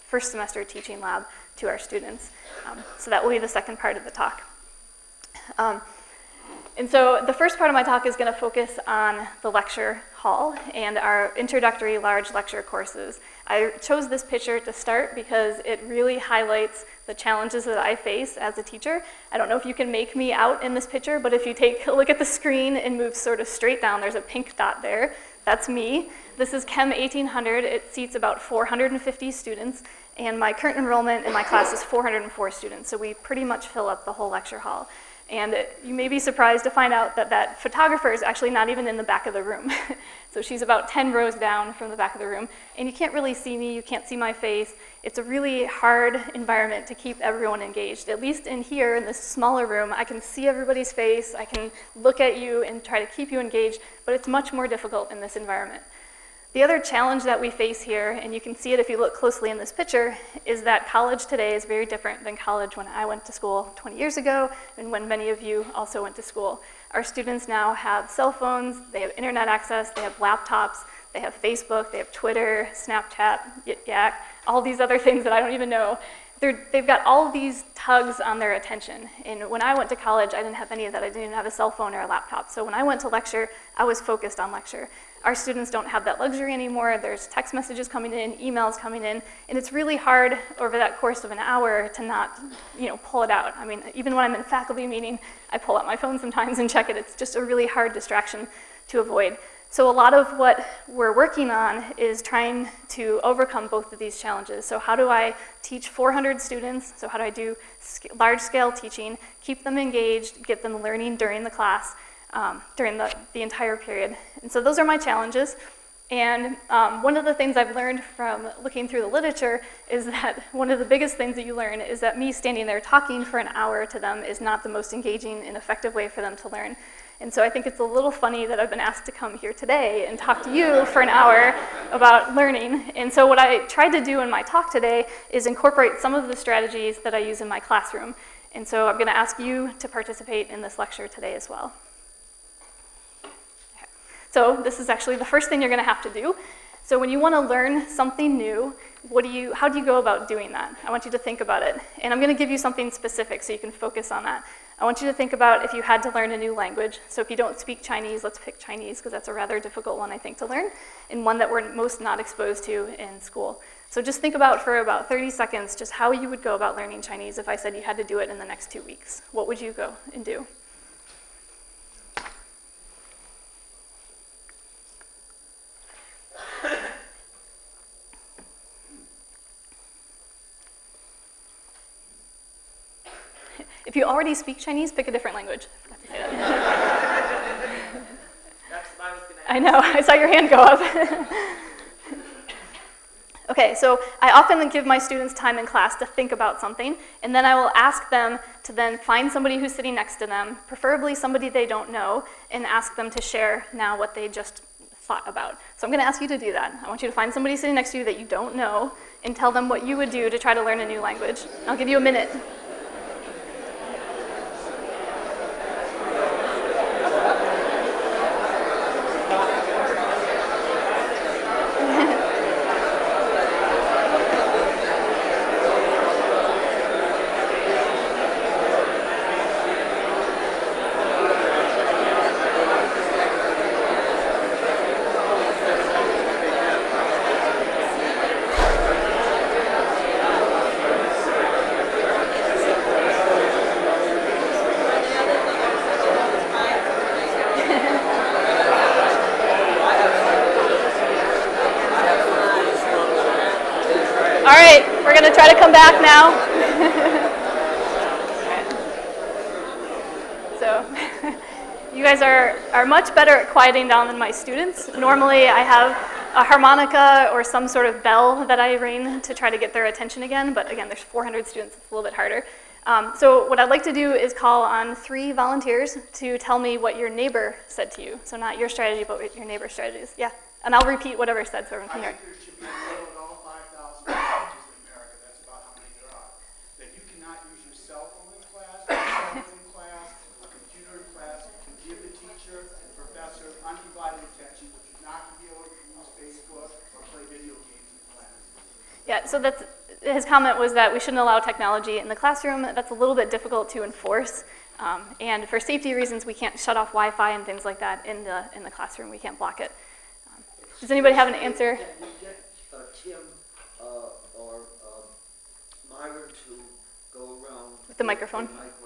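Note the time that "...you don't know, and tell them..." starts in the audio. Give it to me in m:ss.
3:28.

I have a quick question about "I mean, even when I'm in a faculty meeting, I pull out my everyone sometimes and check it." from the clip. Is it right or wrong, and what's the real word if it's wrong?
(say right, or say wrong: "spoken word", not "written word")
wrong: "phone", not "everyone".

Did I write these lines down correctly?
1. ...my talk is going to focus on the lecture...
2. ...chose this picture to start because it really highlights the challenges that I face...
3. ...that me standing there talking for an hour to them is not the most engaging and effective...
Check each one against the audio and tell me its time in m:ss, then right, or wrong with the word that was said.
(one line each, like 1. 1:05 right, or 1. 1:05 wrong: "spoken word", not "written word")
1. 0:07 right
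2. 0:13 right
3. 2:02 right.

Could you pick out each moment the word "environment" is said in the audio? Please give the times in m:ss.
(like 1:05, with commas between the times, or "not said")
0:46, 0:55.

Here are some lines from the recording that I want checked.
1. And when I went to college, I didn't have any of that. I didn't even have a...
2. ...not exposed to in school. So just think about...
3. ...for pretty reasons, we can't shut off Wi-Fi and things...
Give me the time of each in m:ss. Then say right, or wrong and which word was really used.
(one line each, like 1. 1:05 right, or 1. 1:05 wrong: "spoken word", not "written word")
1. 1:19 right
2. 2:42 right
3. 5:05 wrong: "safety", not "pretty".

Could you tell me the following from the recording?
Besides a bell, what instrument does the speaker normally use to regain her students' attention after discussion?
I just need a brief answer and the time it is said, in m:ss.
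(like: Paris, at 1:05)
harmonica, at 4:26.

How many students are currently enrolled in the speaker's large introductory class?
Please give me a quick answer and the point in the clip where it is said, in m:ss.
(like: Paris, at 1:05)
404, at 0:31.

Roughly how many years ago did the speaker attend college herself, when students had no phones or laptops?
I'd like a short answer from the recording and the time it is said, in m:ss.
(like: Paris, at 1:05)
20, at 1:03.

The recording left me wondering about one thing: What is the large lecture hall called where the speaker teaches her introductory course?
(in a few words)
Chem 1800.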